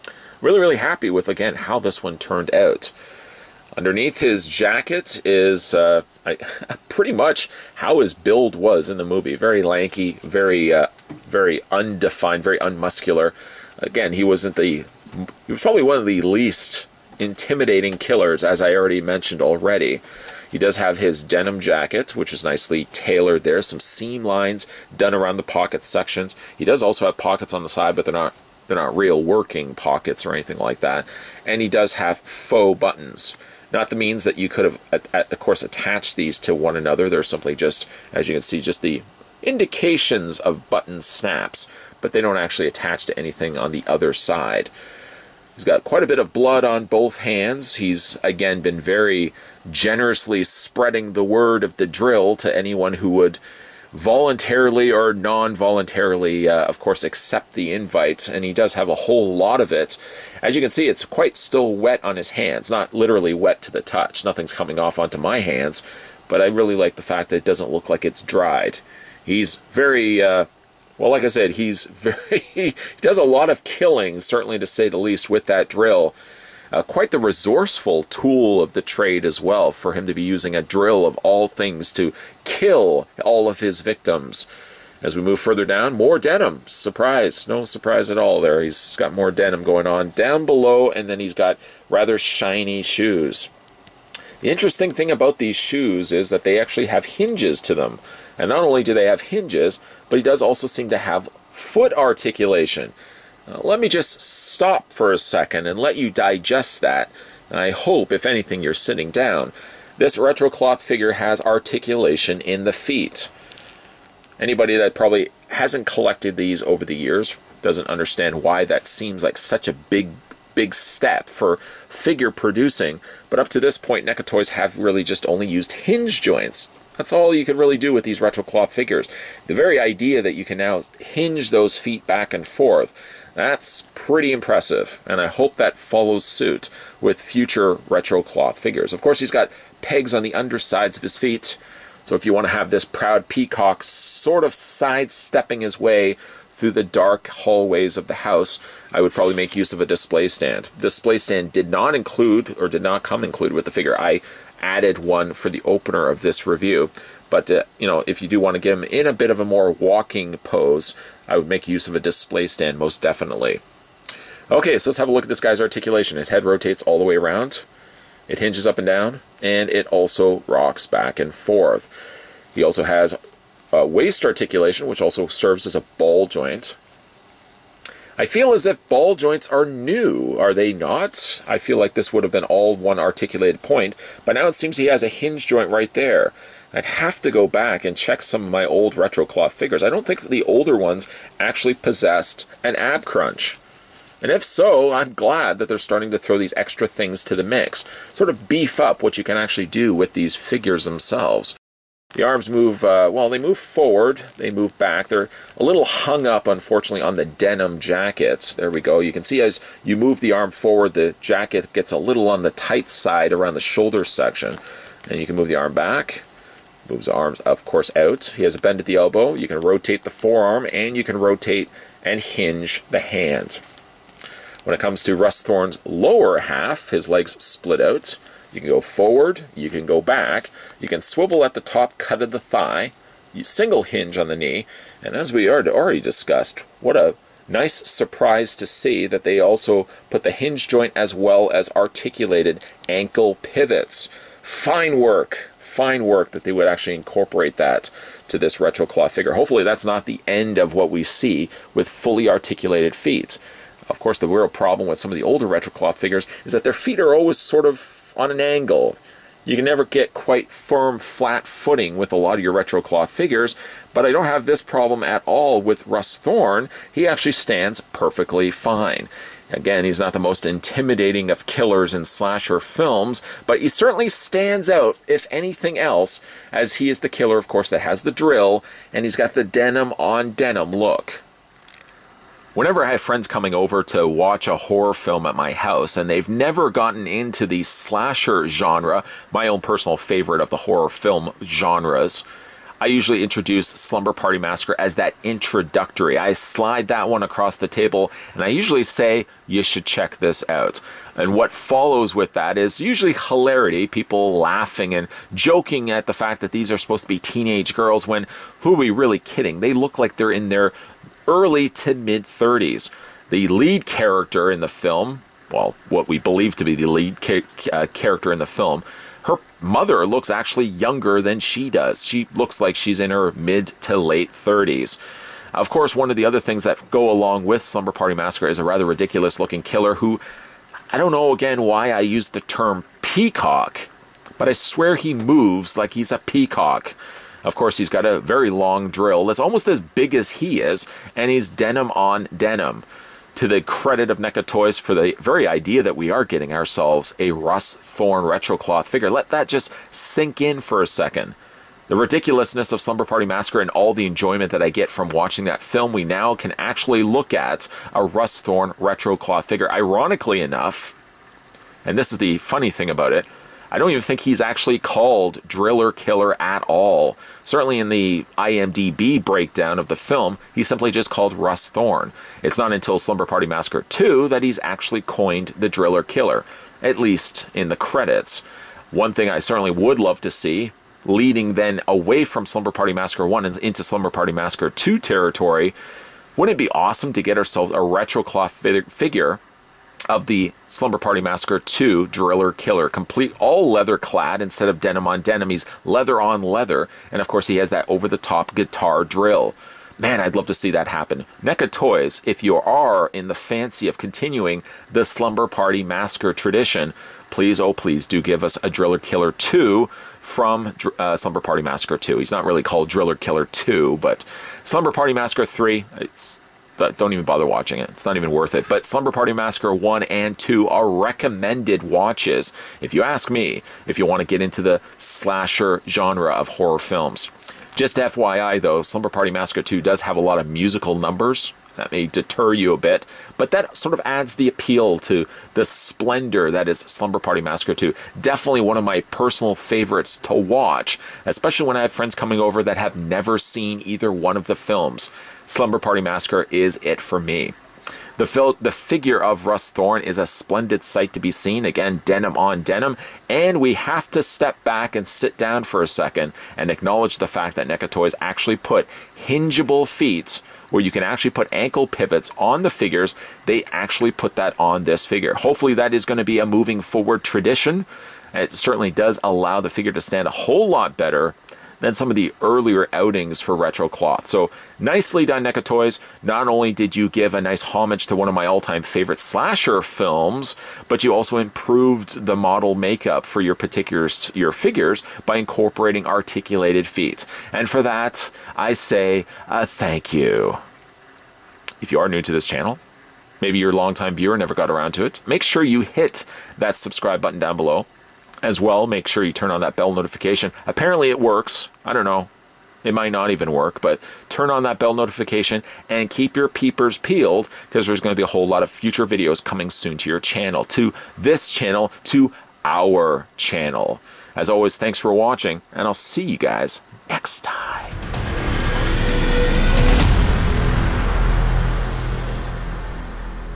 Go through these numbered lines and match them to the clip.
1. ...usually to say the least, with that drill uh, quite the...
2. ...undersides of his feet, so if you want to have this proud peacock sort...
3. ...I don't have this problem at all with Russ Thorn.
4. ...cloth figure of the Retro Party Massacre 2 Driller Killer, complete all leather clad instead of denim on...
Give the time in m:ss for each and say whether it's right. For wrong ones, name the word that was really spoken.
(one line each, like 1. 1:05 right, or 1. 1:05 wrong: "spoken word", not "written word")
1. 1:14 wrong: "certainly", not "usually"
2. 2:20 right
3. 4:24 right
4. 6:28 wrong: "Slumber", not "Retro".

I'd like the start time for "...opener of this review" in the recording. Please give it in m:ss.
2:35.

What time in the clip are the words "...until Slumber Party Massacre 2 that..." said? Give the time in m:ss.
6:12.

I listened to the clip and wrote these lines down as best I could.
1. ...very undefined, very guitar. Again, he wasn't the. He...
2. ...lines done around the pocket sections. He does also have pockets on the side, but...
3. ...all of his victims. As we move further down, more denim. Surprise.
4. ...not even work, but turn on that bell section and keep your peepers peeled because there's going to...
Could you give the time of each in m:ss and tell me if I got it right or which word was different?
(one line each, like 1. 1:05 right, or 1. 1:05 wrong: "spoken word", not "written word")
1. 0:11 wrong: "unmuscular", not "guitar"
2. 0:24 right
3. 1:23 right
4. 8:23 wrong: "notification", not "section".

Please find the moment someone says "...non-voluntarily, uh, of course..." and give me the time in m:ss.
0:55.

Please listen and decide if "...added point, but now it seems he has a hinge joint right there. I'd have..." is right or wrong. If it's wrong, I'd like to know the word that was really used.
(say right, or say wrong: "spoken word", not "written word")
wrong: "articulated", not "added".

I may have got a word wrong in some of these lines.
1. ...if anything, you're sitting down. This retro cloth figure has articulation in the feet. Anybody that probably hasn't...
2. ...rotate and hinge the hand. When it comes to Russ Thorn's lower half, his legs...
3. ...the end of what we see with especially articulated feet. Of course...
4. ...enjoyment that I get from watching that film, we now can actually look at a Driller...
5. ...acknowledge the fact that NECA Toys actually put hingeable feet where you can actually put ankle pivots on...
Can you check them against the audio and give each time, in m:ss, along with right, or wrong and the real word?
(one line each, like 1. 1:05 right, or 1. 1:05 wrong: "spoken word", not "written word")
1. 1:48 right
2. 3:41 right
3. 4:10 wrong: "fully", not "especially"
4. 5:54 wrong: "Russ", not "Driller"
5. 7:36 right.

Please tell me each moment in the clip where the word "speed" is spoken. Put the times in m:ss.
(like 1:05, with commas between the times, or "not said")
not said.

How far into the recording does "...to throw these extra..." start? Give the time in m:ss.
3:16.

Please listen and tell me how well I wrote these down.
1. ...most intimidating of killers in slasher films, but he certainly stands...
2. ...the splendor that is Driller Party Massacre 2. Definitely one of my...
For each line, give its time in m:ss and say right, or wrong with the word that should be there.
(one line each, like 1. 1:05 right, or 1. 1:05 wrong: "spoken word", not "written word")
1. 4:30 right
2. 7:15 wrong: "Slumber", not "Driller".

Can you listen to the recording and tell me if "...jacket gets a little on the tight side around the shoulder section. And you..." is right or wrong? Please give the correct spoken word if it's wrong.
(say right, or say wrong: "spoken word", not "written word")
right.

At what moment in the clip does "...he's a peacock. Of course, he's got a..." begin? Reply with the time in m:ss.
5:35.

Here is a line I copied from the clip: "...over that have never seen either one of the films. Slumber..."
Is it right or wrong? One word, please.
right.